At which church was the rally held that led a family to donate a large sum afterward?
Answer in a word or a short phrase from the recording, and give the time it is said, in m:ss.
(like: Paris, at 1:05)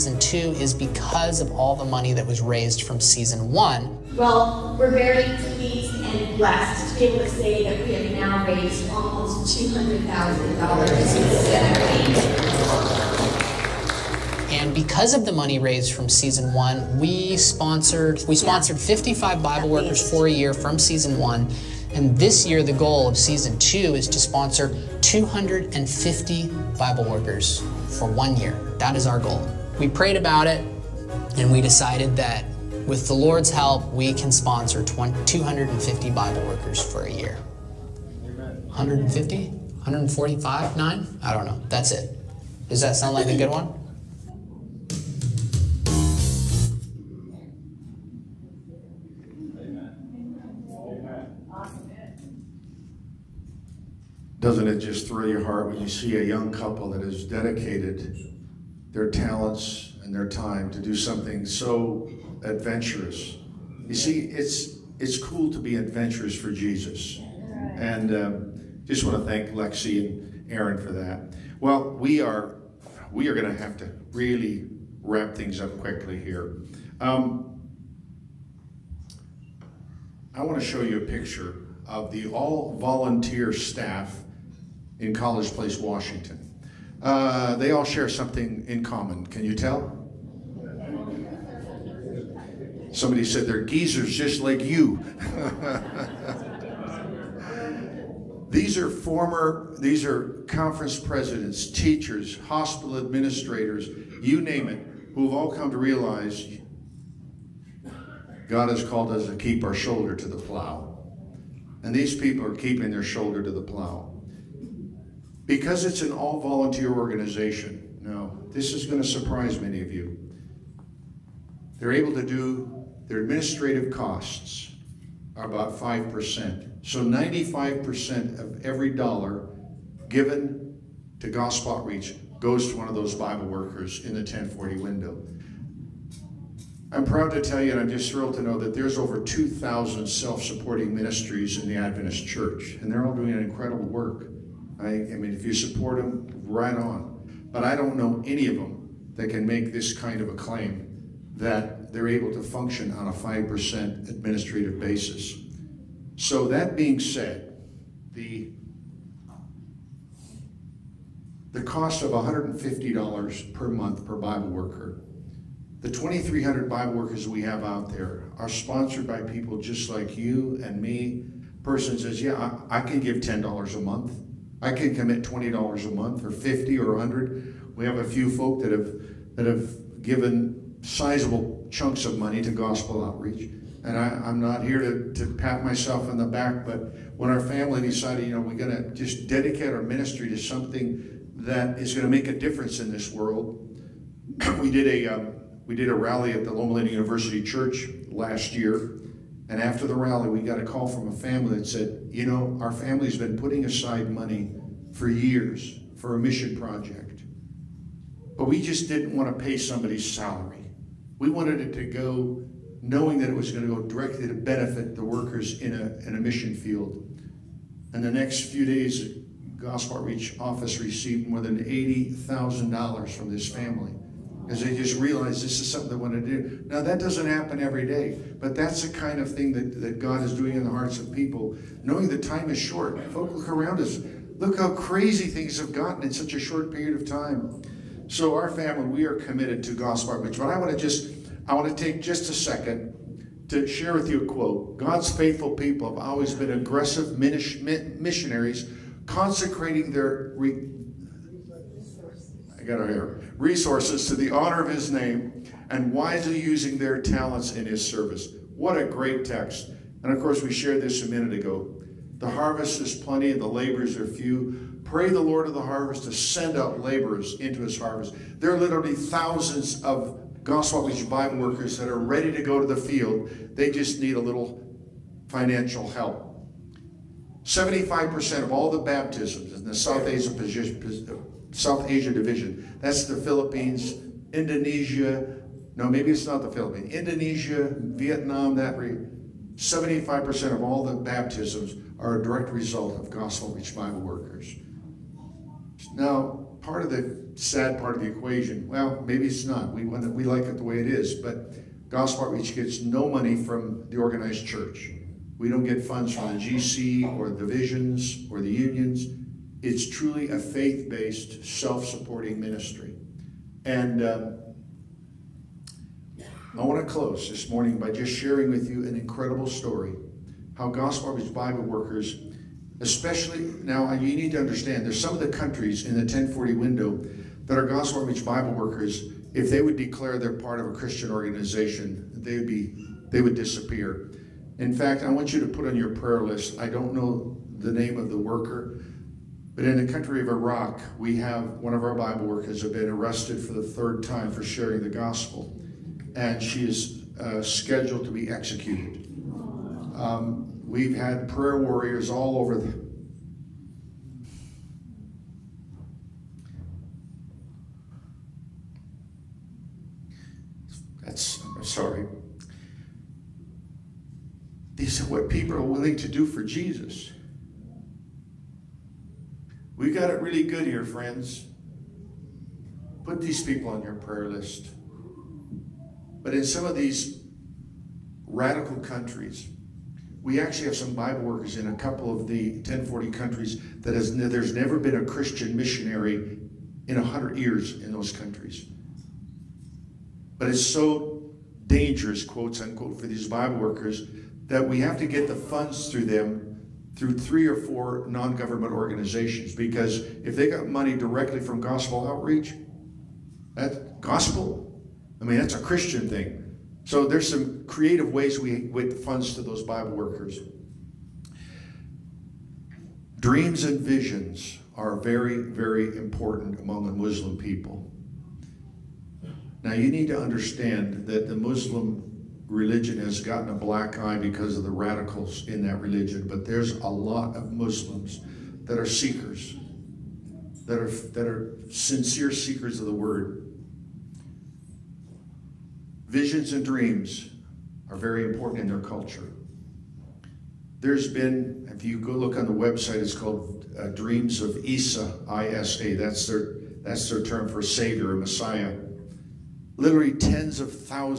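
Loma Linda University Church, at 3:16.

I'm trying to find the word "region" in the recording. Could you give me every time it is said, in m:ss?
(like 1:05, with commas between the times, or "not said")
4:48.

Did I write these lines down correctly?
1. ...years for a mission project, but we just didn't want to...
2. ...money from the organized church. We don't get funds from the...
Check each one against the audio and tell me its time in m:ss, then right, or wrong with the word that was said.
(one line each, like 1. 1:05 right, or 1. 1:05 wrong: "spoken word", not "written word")
1. 3:25 right
2. 5:03 right.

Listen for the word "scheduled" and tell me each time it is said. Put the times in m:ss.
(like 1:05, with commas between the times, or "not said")
5:47.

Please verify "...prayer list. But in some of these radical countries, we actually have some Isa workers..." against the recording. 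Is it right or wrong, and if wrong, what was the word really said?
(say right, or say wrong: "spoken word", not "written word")
wrong: "Bible", not "Isa".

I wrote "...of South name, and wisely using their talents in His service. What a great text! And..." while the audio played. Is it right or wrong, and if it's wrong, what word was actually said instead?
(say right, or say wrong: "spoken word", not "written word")
wrong: "His", not "South".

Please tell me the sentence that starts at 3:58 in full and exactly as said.
So our family, we are committed to gospel outreach.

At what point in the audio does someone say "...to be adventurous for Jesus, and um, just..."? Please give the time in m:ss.
1:05.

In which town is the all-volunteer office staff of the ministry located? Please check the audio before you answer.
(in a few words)
College Place, Washington.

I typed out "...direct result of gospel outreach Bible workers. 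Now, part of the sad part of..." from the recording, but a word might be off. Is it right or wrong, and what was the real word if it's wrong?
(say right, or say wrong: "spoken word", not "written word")
right.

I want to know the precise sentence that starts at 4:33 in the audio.
They just need a little financial help.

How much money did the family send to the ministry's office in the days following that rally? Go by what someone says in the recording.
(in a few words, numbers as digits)
more than $80,000.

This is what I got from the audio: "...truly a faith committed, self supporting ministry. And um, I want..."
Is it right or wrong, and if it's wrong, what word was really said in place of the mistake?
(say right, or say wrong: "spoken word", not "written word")
wrong: "based", not "committed".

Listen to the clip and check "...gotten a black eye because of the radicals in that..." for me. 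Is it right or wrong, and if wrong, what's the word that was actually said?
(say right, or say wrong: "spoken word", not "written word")
right.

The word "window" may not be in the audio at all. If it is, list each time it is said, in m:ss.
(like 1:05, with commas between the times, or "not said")
2:14, 5:26.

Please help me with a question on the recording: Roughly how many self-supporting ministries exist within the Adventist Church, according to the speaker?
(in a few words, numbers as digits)
over 2,000.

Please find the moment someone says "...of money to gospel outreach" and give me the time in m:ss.
3:02.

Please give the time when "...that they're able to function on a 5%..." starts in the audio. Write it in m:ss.
2:31.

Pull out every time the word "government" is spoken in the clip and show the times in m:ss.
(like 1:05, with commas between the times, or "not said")
6:38.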